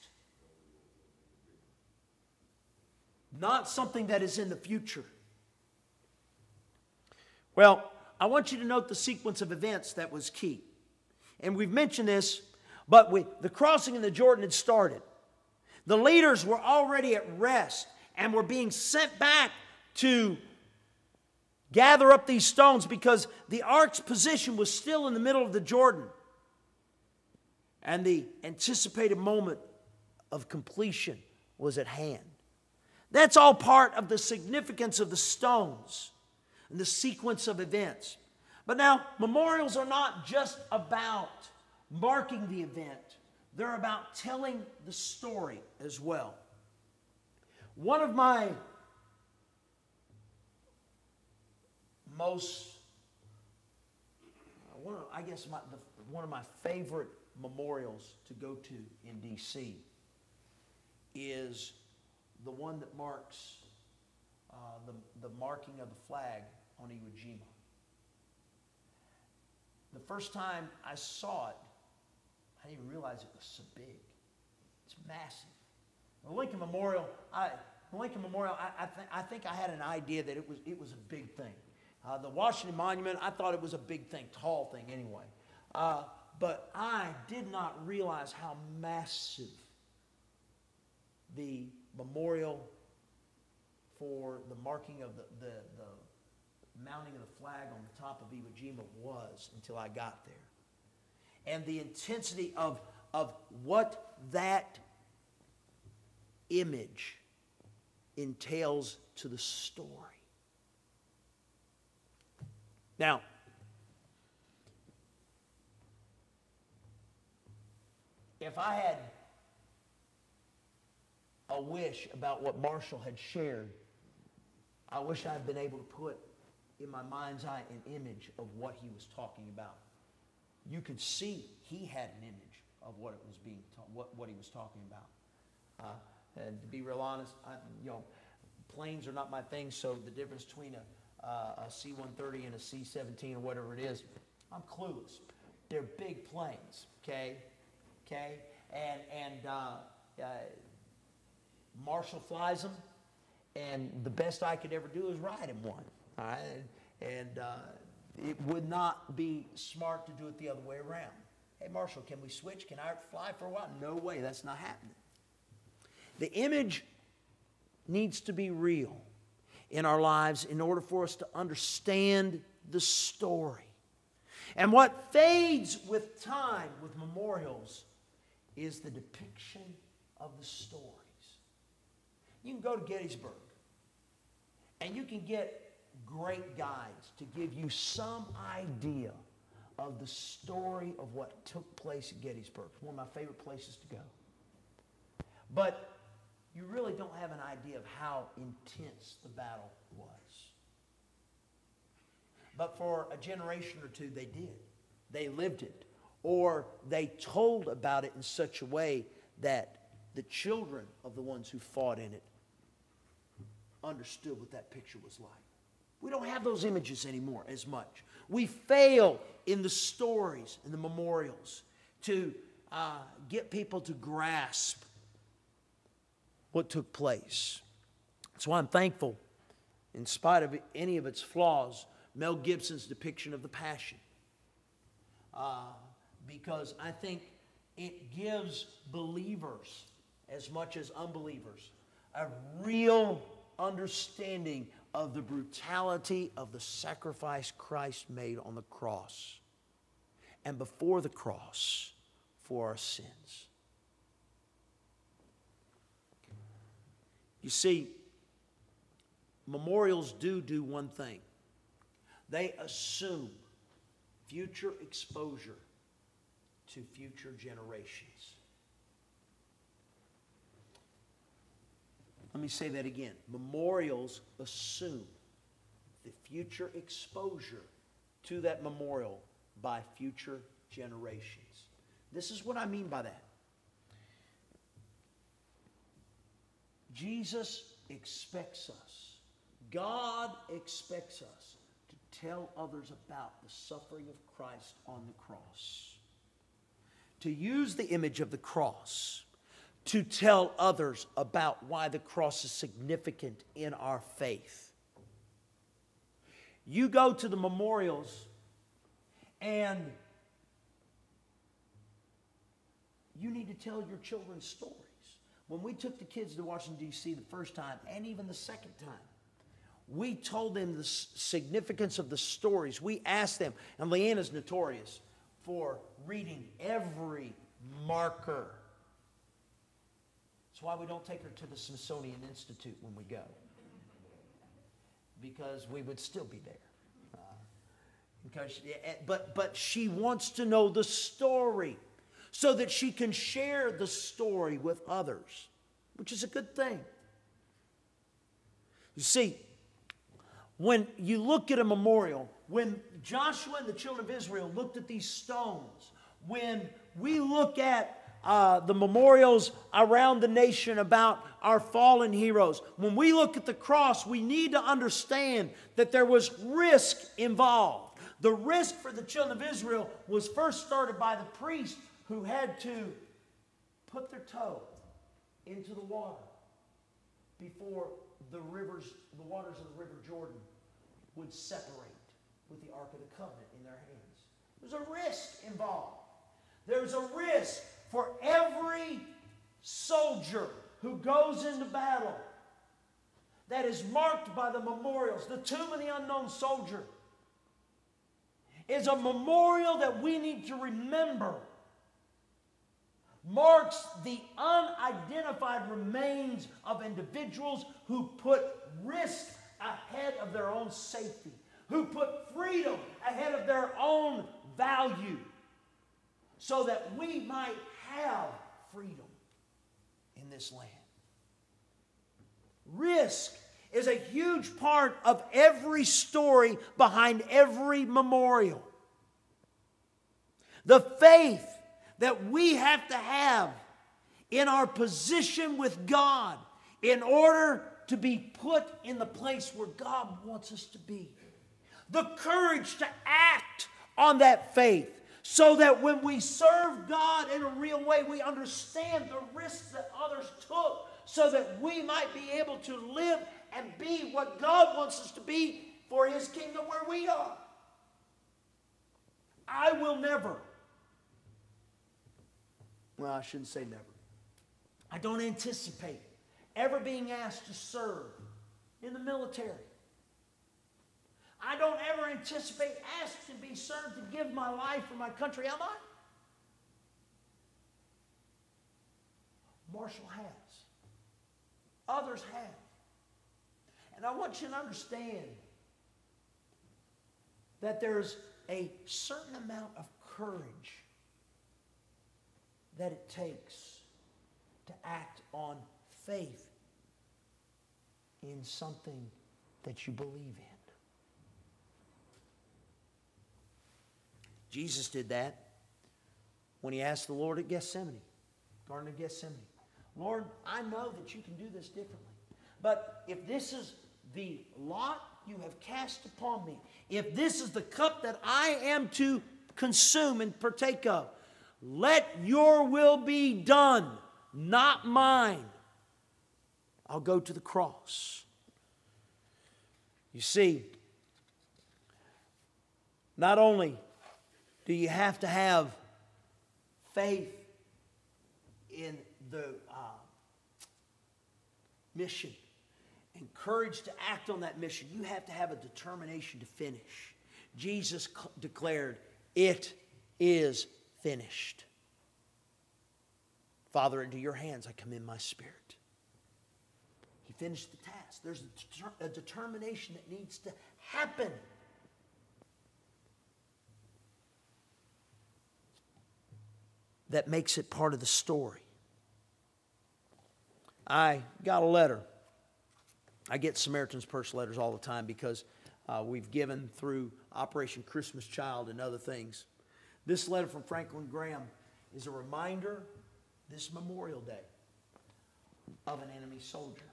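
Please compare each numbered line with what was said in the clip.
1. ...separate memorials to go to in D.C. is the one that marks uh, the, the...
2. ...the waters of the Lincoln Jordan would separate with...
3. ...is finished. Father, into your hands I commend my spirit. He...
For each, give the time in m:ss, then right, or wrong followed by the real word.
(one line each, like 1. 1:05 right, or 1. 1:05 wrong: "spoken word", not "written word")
1. 0:56 wrong: "favorite", not "separate"
2. 6:19 wrong: "River", not "Lincoln"
3. 9:10 right.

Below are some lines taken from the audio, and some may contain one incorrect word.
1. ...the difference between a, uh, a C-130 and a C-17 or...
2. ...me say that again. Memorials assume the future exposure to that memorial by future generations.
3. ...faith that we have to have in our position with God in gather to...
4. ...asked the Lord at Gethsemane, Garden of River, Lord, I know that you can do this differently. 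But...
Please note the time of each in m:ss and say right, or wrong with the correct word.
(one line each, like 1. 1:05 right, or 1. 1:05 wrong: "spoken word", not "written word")
1. 2:20 right
2. 4:32 right
3. 7:10 wrong: "order", not "gather"
4. 8:26 wrong: "Gethsemane", not "River".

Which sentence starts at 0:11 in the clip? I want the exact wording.
And we've mentioned this, but we, the crossing in the Jordan had started.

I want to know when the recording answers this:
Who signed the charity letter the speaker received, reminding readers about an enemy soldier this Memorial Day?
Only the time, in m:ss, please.
9:40.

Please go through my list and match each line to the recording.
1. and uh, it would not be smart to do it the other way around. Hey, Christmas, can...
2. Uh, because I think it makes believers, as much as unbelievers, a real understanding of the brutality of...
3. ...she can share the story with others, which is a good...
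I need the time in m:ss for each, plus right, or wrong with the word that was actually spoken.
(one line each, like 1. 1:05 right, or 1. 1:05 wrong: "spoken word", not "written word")
1. 2:37 wrong: "Marshall", not "Christmas"
2. 3:55 wrong: "gives", not "makes"
3. 5:42 right.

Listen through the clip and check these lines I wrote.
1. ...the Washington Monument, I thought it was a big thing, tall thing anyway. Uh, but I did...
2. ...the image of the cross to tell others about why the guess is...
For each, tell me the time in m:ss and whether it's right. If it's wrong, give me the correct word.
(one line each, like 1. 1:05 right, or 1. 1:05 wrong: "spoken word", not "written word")
1. 1:22 right
2. 4:57 wrong: "cross", not "guess".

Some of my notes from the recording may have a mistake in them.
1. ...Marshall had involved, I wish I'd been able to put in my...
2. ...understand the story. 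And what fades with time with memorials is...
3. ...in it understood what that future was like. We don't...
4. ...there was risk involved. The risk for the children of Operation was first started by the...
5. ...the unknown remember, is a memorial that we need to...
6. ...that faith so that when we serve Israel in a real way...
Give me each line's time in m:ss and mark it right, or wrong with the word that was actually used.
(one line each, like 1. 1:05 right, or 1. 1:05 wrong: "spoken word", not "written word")
1. 2:02 wrong: "shared", not "involved"
2. 2:51 right
3. 3:31 wrong: "picture", not "future"
4. 6:05 wrong: "Israel", not "Operation"
5. 6:35 wrong: "soldier", not "remember"
6. 7:24 wrong: "God", not "Israel".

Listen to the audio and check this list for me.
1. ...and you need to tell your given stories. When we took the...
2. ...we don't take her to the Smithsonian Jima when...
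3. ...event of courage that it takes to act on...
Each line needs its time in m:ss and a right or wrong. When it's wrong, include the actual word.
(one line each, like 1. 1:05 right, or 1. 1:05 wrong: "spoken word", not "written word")
1. 5:09 wrong: "children", not "given"
2. 5:30 wrong: "Institute", not "Jima"
3. 8:09 wrong: "amount", not "event".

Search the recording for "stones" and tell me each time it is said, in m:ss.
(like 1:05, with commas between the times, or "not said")
0:22, 0:35, 5:55.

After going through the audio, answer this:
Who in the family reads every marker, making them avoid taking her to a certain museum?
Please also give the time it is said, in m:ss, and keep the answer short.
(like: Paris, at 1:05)
Leanna, at 5:23.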